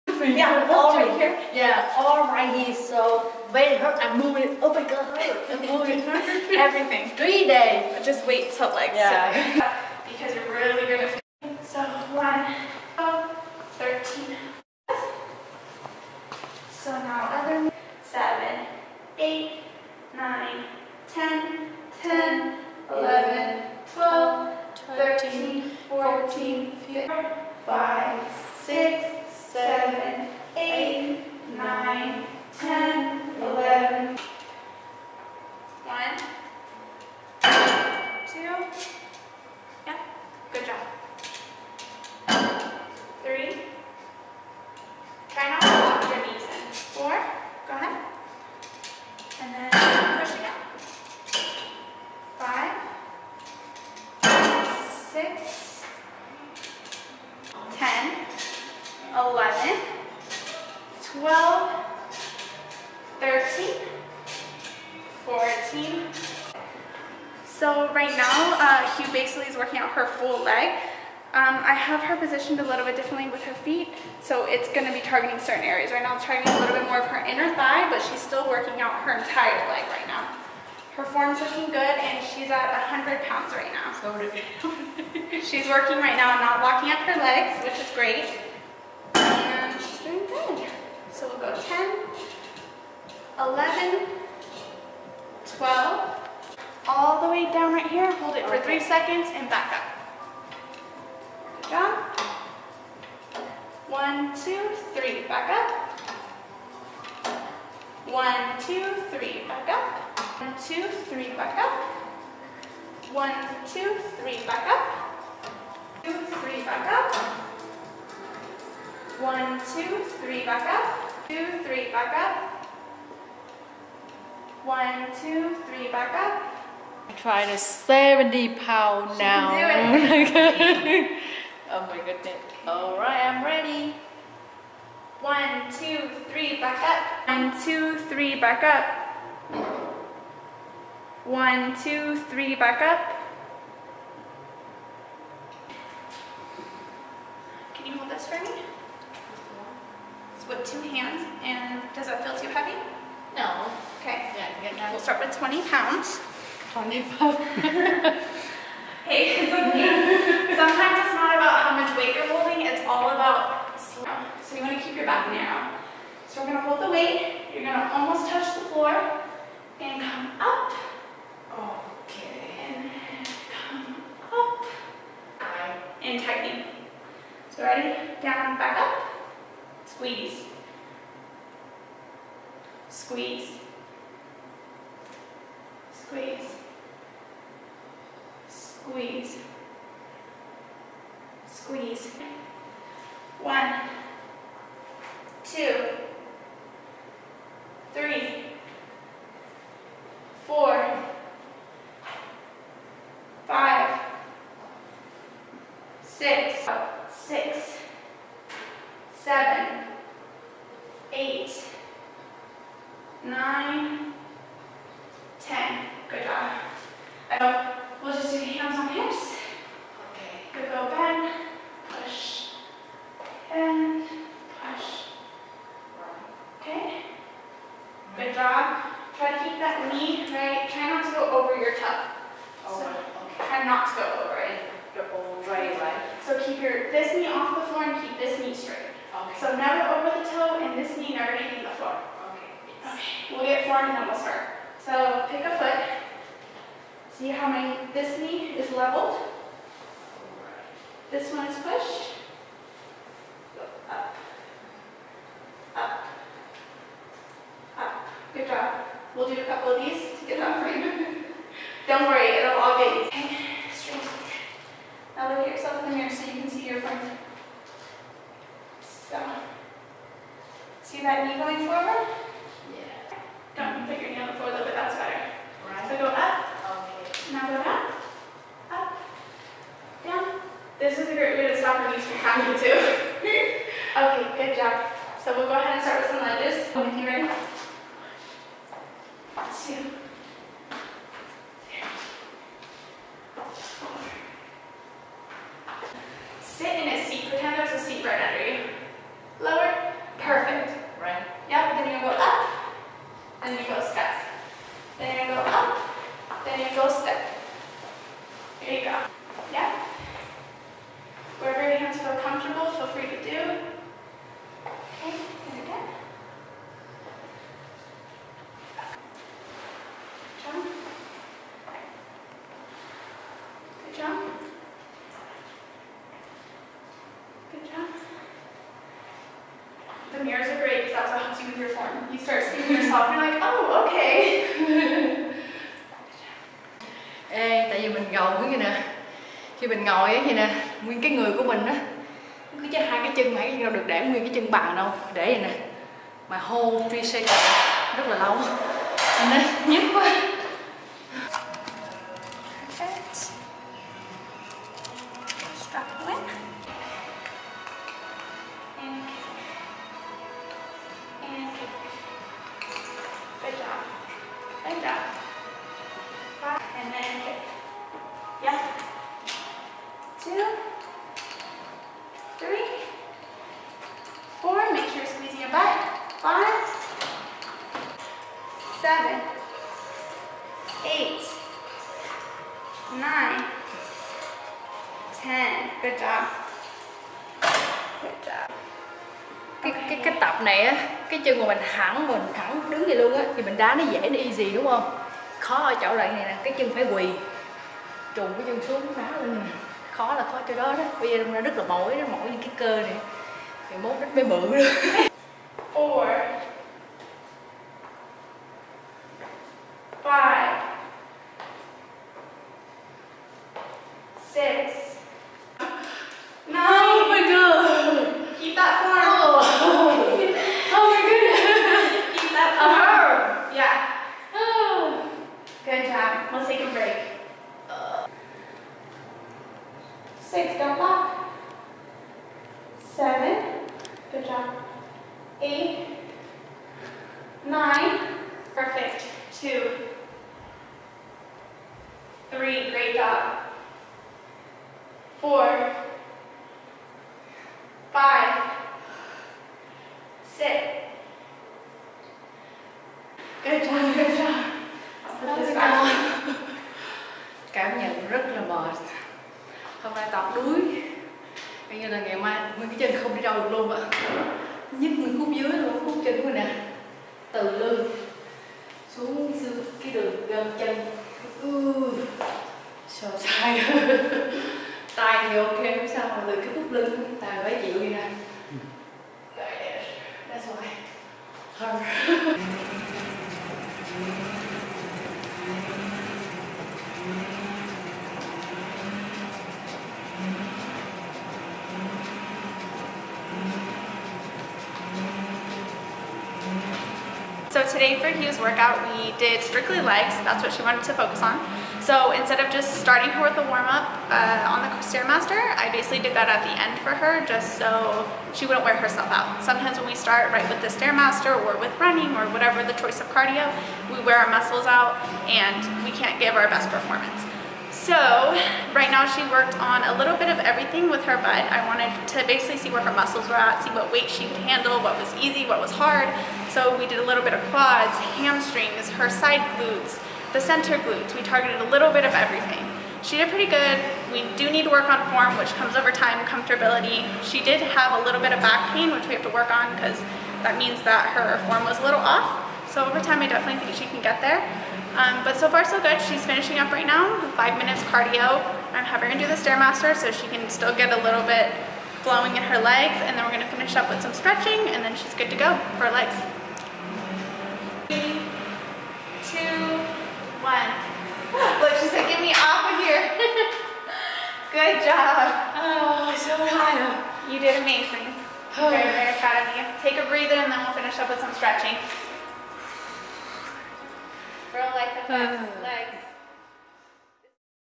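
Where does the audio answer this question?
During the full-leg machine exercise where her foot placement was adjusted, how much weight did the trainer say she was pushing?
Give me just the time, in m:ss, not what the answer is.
1:22.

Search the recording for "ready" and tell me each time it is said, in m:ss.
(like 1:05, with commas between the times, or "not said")
2:13, 2:57, 4:47.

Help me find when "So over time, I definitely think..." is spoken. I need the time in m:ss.
9:02.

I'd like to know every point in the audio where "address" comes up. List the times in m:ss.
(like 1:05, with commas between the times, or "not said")
not said.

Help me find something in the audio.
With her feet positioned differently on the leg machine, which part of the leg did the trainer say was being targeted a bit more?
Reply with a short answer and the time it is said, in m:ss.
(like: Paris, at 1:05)
inner thigh, at 1:17.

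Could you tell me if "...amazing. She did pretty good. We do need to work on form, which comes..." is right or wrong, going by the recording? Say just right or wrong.
wrong.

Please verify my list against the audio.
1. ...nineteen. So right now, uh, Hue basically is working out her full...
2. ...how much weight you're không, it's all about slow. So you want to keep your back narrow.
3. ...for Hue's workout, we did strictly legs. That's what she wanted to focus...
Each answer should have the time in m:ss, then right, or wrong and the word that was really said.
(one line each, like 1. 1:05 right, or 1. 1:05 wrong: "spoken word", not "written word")
1. 1:05 wrong: "fourteen", not "nineteen"
2. 2:41 wrong: "holding", not "không"
3. 8:17 right.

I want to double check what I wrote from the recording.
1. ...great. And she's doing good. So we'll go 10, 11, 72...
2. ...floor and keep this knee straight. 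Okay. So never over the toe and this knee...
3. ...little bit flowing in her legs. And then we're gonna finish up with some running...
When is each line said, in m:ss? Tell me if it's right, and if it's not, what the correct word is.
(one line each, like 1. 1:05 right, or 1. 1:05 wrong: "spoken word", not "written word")
1. 1:27 wrong: "12", not "72"
2. 3:57 right
3. 9:11 wrong: "stretching", not "running".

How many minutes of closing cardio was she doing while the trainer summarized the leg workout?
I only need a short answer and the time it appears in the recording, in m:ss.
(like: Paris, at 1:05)
5, at 9:07.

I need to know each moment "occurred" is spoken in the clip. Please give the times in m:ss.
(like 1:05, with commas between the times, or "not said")
not said.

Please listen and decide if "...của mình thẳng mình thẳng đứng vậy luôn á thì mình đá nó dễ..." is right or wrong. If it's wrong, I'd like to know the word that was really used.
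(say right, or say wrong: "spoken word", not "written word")
right.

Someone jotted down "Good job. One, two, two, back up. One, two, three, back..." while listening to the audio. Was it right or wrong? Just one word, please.
wrong.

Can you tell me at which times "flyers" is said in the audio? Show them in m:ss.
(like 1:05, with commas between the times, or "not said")
not said.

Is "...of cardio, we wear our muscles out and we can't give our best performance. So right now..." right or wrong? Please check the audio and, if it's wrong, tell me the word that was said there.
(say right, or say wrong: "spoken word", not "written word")
right.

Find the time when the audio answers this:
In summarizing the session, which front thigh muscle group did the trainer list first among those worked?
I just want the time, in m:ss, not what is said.
8:47.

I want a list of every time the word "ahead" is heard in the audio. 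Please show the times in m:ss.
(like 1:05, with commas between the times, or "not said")
4:45.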